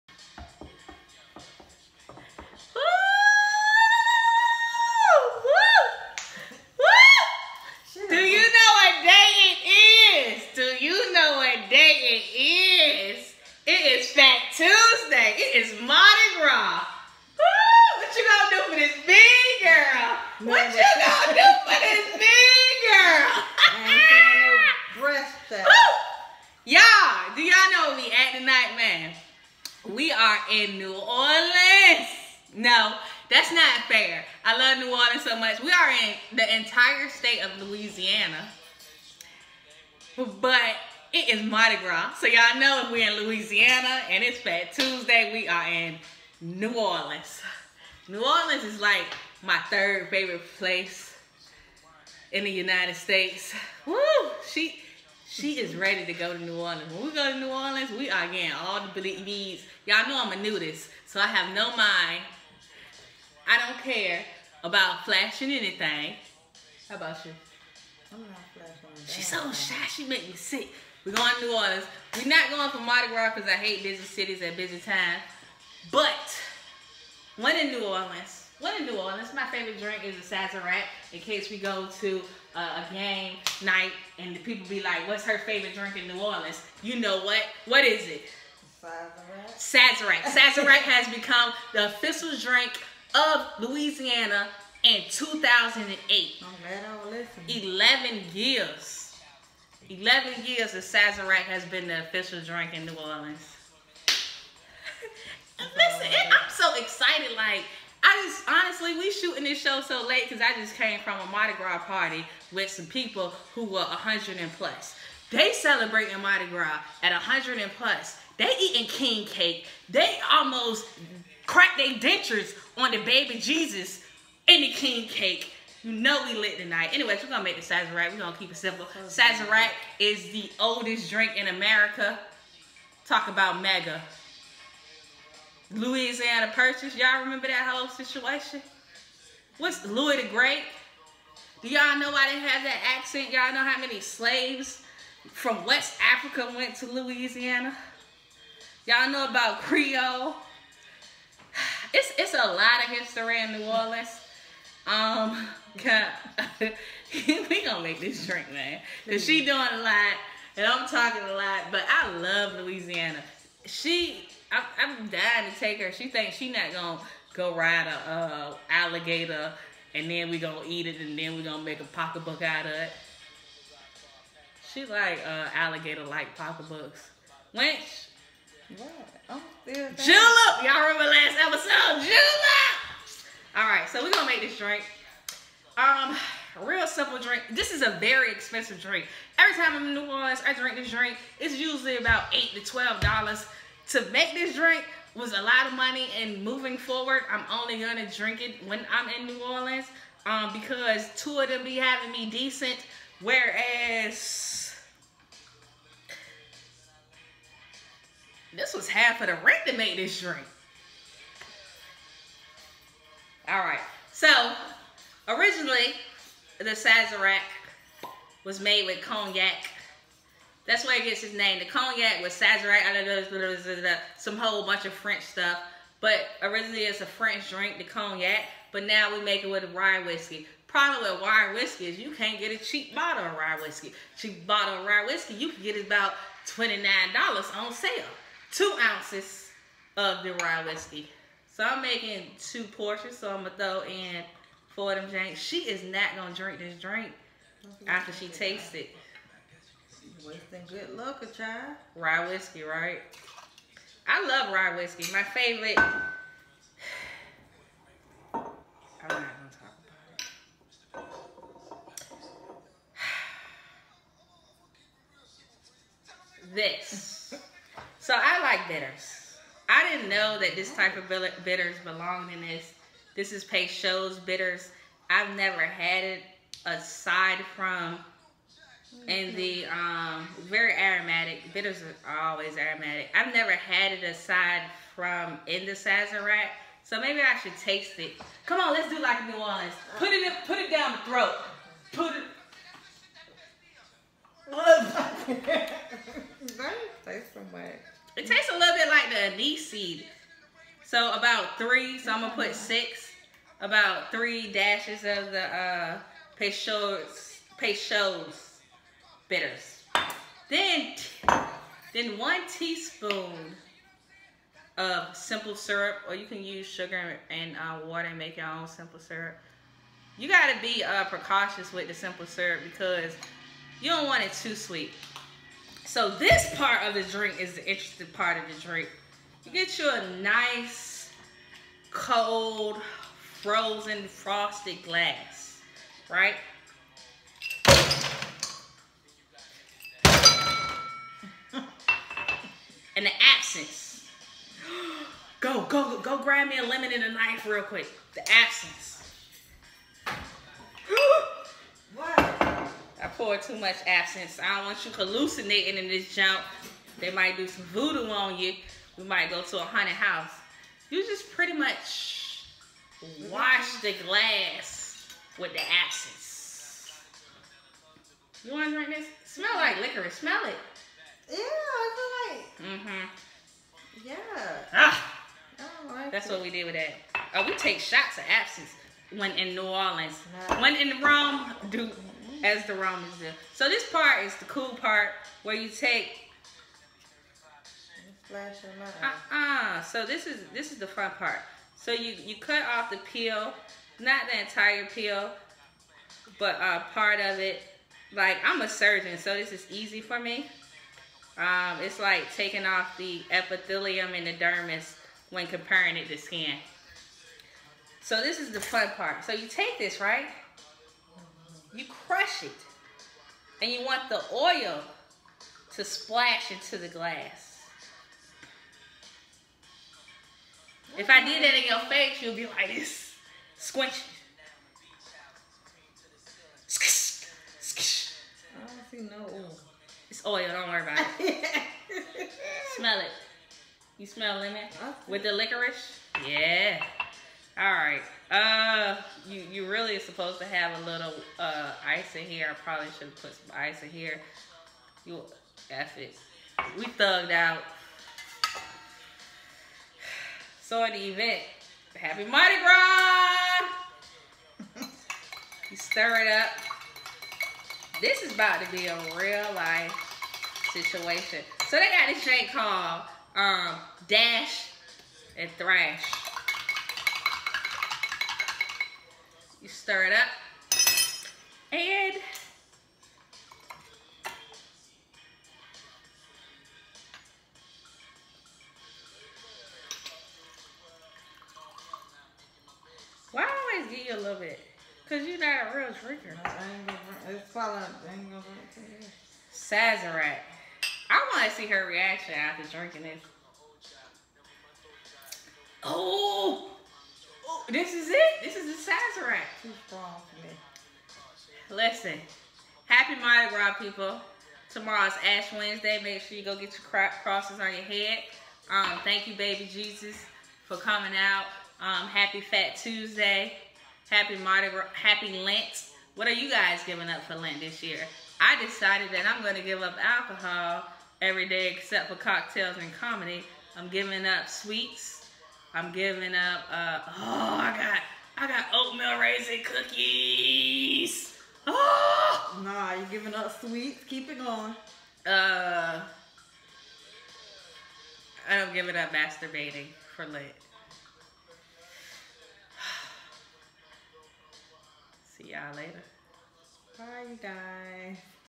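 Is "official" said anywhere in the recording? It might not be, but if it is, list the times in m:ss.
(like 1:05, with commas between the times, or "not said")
1:31, 1:42.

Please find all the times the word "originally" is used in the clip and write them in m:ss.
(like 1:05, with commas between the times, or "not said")
3:35, 3:46.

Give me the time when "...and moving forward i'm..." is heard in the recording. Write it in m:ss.
3:16.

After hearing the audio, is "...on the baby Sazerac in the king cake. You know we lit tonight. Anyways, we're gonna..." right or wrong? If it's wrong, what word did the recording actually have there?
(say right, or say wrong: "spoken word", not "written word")
wrong: "Jesus", not "Sazerac".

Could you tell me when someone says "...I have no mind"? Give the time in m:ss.
1:01.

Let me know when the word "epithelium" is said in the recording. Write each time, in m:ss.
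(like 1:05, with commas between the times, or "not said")
6:43.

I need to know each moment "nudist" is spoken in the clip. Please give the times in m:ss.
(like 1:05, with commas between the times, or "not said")
1:00.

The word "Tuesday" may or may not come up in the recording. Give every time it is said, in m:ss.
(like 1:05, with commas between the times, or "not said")
0:44, 8:32.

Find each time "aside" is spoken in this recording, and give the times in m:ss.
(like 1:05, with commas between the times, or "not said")
4:36, 4:44.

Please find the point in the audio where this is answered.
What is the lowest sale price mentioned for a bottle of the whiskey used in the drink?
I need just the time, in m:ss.
3:56.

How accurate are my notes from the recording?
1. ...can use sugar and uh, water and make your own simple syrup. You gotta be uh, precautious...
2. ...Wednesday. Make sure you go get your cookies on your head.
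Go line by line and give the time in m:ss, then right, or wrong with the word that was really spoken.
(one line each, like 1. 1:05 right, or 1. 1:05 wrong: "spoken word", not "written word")
1. 5:16 right
2. 8:25 wrong: "crosses", not "cookies".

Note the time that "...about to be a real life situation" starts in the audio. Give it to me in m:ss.
7:38.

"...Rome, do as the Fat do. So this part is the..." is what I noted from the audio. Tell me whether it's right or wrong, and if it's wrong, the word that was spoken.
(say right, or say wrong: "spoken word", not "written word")
wrong: "Romans", not "Fat".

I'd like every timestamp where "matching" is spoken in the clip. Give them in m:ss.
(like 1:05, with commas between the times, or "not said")
not said.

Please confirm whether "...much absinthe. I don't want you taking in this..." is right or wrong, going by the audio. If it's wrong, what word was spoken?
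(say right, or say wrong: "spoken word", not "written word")
wrong: "hallucinating", not "taking".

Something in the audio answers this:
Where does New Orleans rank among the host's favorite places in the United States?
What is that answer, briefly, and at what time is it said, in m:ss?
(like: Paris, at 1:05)
third, at 0:49.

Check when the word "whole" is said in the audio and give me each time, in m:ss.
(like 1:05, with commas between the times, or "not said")
2:17, 3:44.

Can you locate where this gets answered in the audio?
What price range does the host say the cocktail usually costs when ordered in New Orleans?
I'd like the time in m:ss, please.
3:12.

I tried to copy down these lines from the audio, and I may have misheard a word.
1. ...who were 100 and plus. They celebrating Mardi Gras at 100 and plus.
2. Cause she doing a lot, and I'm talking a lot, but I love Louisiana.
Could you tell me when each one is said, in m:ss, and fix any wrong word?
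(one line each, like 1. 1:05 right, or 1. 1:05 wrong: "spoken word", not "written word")
1. 1:53 right
2. 2:39 right.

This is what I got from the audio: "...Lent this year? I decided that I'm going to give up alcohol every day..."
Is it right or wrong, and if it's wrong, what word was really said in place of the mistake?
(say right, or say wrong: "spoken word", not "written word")
right.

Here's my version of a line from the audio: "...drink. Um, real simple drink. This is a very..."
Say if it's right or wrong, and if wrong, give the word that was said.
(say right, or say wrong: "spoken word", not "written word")
right.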